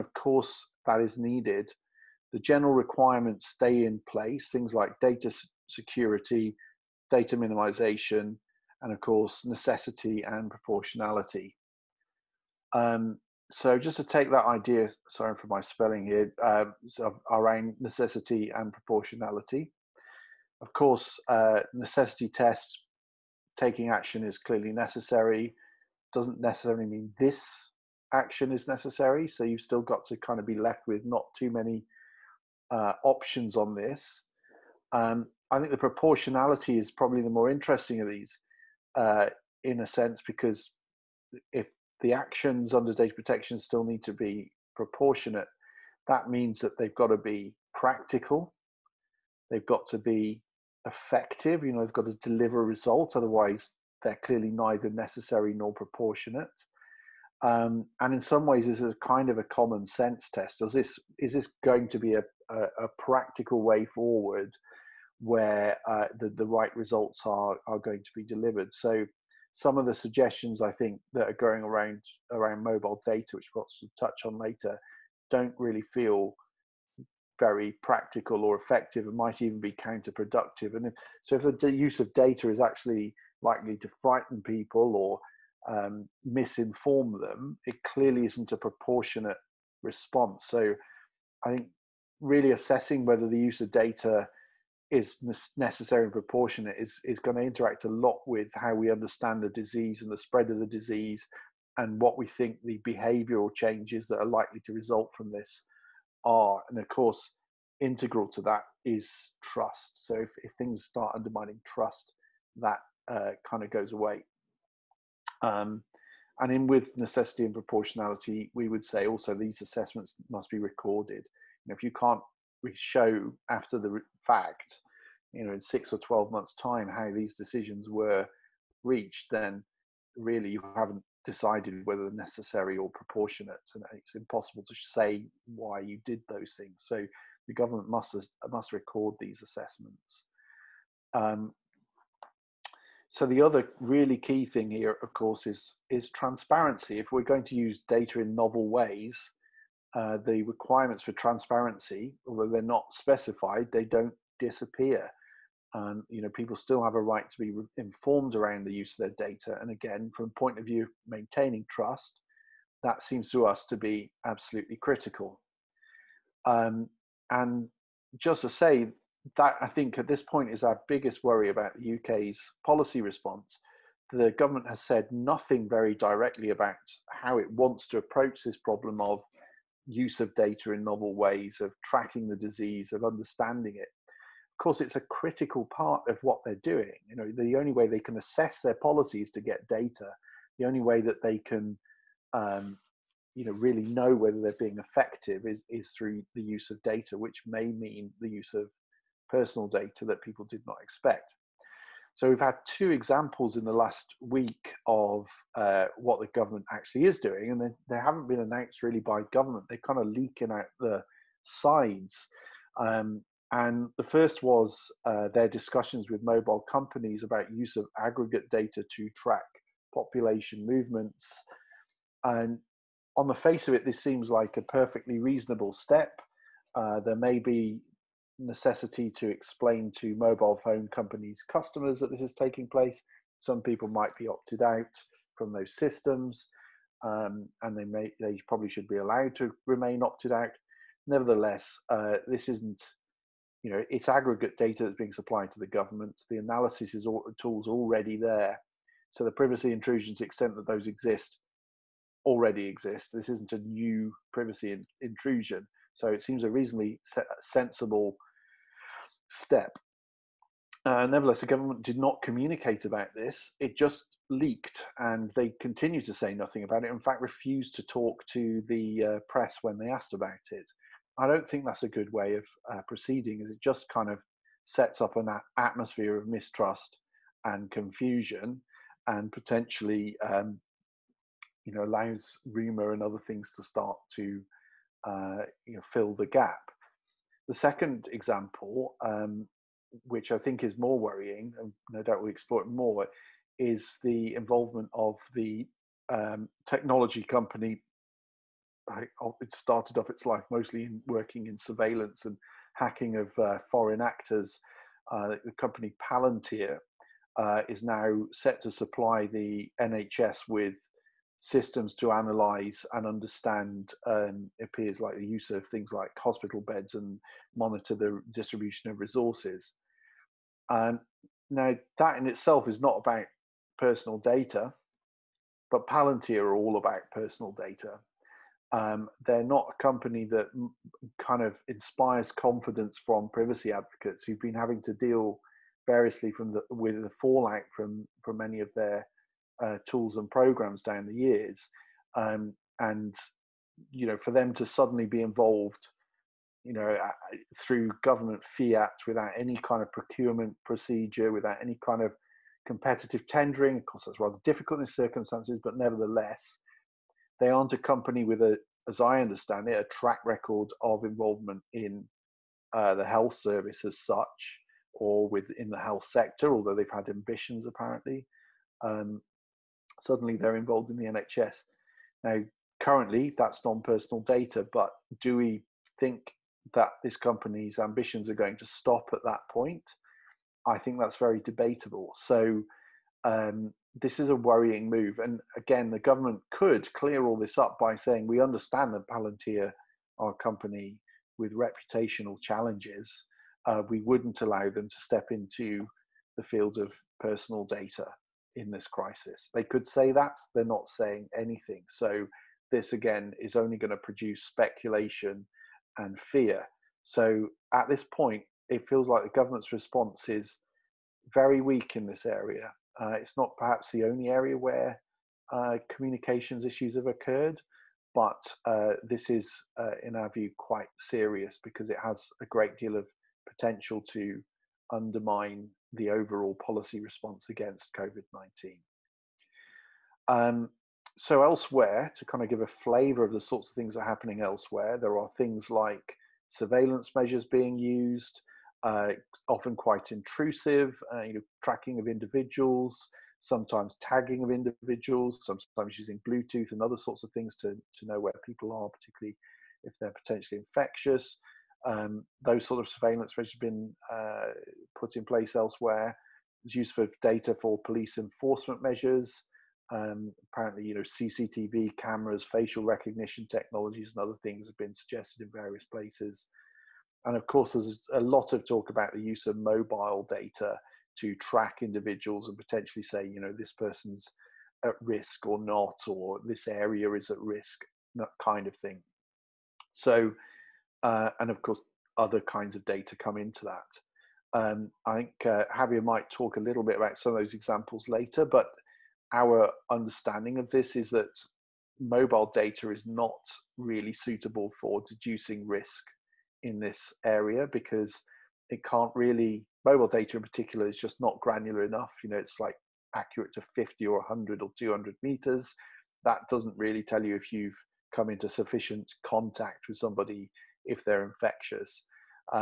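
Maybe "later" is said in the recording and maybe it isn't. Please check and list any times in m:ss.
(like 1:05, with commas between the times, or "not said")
1:14, 8:08.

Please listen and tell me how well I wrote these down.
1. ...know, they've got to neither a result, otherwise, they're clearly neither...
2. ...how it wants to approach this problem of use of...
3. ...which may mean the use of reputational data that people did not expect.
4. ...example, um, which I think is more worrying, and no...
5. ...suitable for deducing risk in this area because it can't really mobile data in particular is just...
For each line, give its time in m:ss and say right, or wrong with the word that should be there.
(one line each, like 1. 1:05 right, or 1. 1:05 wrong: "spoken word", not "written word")
1. 0:51 wrong: "deliver", not "neither"
2. 2:57 right
3. 3:17 wrong: "personal", not "reputational"
4. 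4:48 right
5. 8:14 right.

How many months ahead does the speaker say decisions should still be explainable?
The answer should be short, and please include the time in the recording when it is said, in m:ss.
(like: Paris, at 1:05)
12, at 2:05.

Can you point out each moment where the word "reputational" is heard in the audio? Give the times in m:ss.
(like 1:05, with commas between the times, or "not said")
6:31.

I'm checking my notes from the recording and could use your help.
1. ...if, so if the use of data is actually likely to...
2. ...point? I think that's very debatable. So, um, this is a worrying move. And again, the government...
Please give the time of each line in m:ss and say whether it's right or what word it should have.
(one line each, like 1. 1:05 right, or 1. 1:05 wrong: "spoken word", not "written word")
1. 1:20 right
2. 6:19 right.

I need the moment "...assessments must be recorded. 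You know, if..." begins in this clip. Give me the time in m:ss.
1:59.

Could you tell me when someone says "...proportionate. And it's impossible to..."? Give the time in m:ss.
2:12.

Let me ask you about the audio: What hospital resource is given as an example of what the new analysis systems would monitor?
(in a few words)
Hospital beds.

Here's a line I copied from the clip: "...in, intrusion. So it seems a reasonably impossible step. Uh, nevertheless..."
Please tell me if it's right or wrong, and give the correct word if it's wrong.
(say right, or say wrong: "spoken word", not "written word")
wrong: "sensible", not "impossible".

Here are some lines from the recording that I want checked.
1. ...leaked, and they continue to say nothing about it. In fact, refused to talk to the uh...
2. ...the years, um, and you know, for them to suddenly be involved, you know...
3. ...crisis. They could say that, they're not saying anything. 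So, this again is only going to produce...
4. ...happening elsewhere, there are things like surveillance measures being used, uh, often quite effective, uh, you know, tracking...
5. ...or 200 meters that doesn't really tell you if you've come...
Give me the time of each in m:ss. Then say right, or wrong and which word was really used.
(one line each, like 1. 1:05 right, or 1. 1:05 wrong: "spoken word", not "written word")
1. 4:24 right
2. 5:41 right
3. 6:38 right
4. 7:14 wrong: "intrusive", not "effective"
5. 8:24 right.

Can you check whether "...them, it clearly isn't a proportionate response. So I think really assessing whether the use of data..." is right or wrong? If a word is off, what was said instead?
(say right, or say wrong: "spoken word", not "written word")
right.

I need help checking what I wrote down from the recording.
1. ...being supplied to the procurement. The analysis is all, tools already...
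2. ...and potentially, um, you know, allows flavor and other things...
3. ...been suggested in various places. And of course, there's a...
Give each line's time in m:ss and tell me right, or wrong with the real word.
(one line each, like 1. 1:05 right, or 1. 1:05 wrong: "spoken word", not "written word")
1. 4:04 wrong: "government", not "procurement"
2. 4:39 wrong: "rumor", not "flavor"
3. 7:44 right.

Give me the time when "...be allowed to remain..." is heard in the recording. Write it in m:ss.
3:58.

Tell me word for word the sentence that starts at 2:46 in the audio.
Um, and just to say, that I think at this point is our biggest worry about the UK's policy response.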